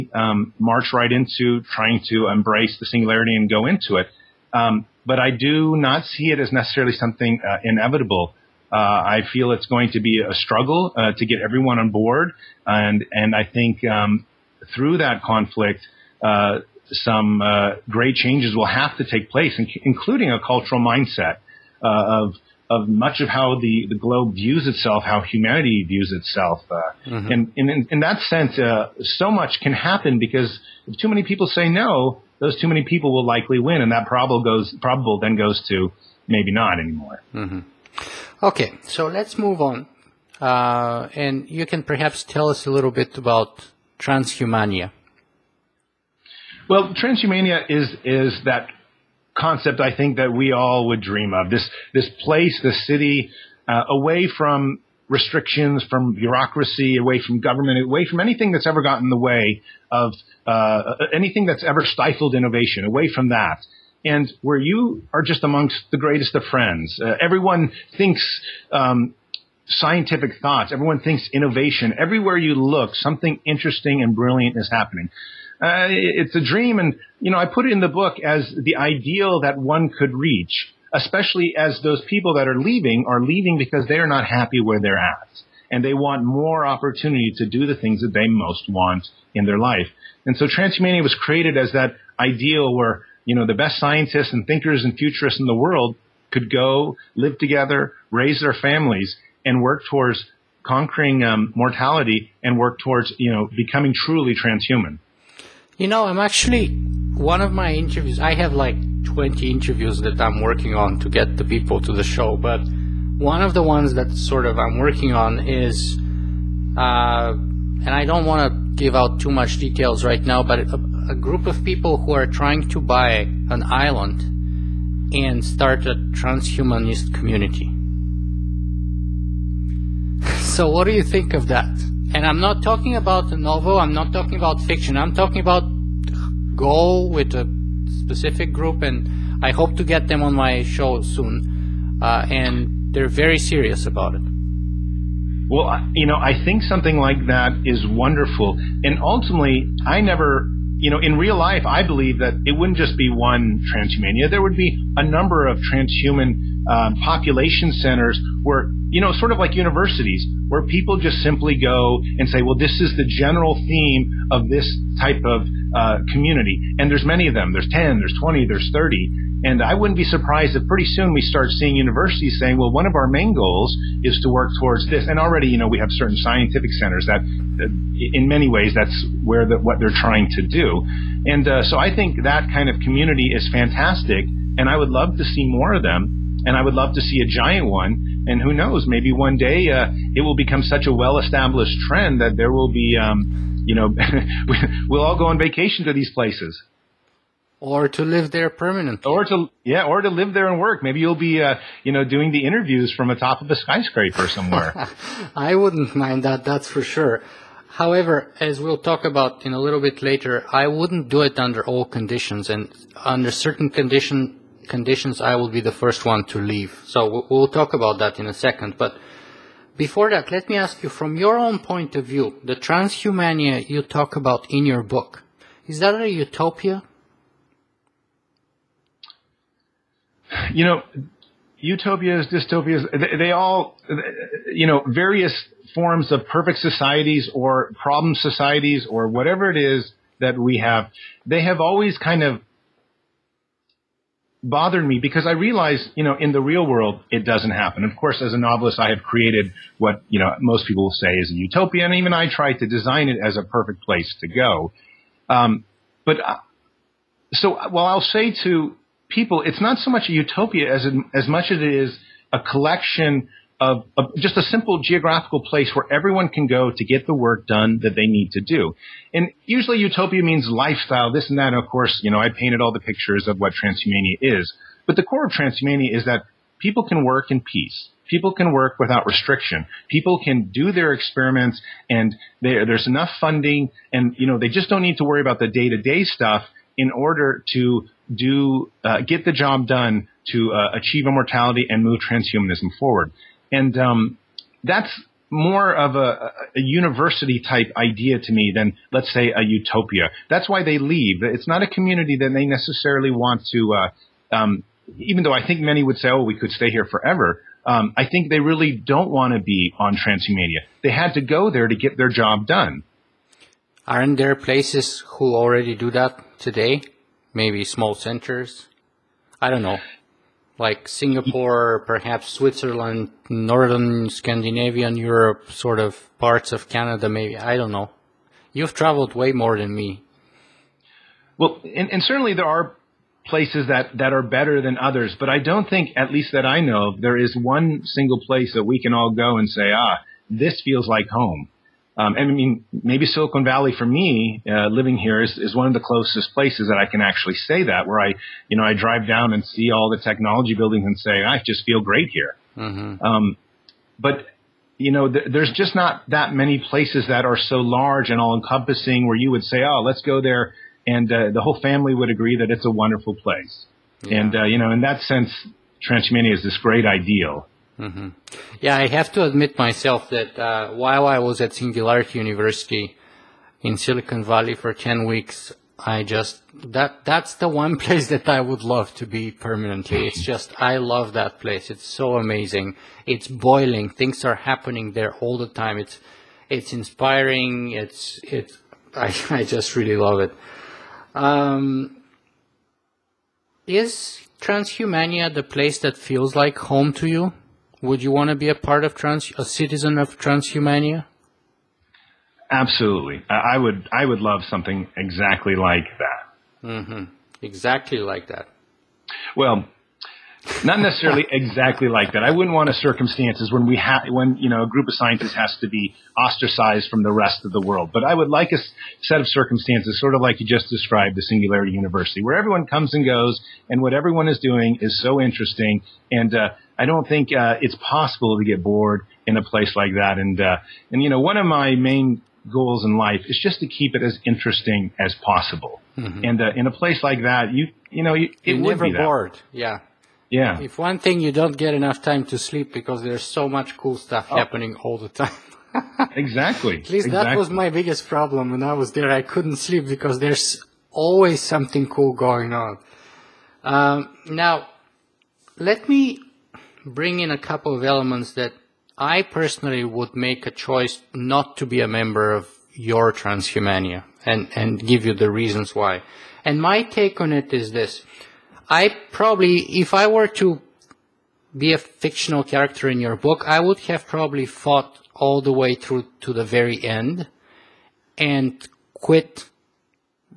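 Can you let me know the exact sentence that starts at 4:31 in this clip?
And of course, you know, I painted all the pictures of what transhumania is.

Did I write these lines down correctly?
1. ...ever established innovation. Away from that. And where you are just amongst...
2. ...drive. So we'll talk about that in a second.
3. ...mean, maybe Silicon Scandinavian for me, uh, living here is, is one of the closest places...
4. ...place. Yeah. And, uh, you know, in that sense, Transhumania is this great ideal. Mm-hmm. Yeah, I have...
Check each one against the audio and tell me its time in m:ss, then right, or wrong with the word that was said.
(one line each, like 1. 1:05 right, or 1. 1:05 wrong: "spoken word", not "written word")
1. 1:01 wrong: "stifled", not "established"
2. 3:36 wrong: "leave", not "drive"
3. 5:42 wrong: "Valley", not "Scandinavian"
4. 6:03 right.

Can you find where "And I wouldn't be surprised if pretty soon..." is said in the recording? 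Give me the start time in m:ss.
2:49.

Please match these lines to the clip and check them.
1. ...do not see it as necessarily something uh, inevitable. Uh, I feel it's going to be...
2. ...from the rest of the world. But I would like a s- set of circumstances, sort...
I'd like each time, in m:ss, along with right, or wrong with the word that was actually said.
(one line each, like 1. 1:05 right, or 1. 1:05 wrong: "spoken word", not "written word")
1. 0:05 right
2. 6:56 right.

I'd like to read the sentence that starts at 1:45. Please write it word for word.
You know, I'm actually one of my interviews.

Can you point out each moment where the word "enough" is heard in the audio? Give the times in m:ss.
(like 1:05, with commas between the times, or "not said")
4:42, 7:21.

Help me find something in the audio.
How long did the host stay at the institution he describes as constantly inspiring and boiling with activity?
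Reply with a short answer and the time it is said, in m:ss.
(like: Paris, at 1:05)
10 weeks, at 6:14.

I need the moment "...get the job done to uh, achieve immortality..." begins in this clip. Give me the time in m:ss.
4:49.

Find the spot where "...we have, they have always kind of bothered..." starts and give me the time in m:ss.
4:00.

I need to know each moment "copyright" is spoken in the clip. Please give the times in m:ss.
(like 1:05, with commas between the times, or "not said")
not said.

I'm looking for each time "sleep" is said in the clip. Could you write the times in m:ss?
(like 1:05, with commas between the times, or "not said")
7:22, 7:29.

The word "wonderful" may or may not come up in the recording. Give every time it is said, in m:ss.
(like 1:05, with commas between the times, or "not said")
2:27, 6:02.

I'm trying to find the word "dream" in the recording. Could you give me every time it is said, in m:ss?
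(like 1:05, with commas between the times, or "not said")
0:51, 1:16.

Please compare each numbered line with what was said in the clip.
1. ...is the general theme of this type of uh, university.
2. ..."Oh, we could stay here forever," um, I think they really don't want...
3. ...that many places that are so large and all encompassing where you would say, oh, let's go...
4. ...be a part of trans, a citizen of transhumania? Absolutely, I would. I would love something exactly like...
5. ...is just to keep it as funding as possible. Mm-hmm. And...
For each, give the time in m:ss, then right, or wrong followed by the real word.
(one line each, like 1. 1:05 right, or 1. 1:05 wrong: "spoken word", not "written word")
1. 2:42 wrong: "community", not "university"
2. 5:06 right
3. 5:56 right
4. 6:38 right
5. 7:13 wrong: "interesting", not "funding".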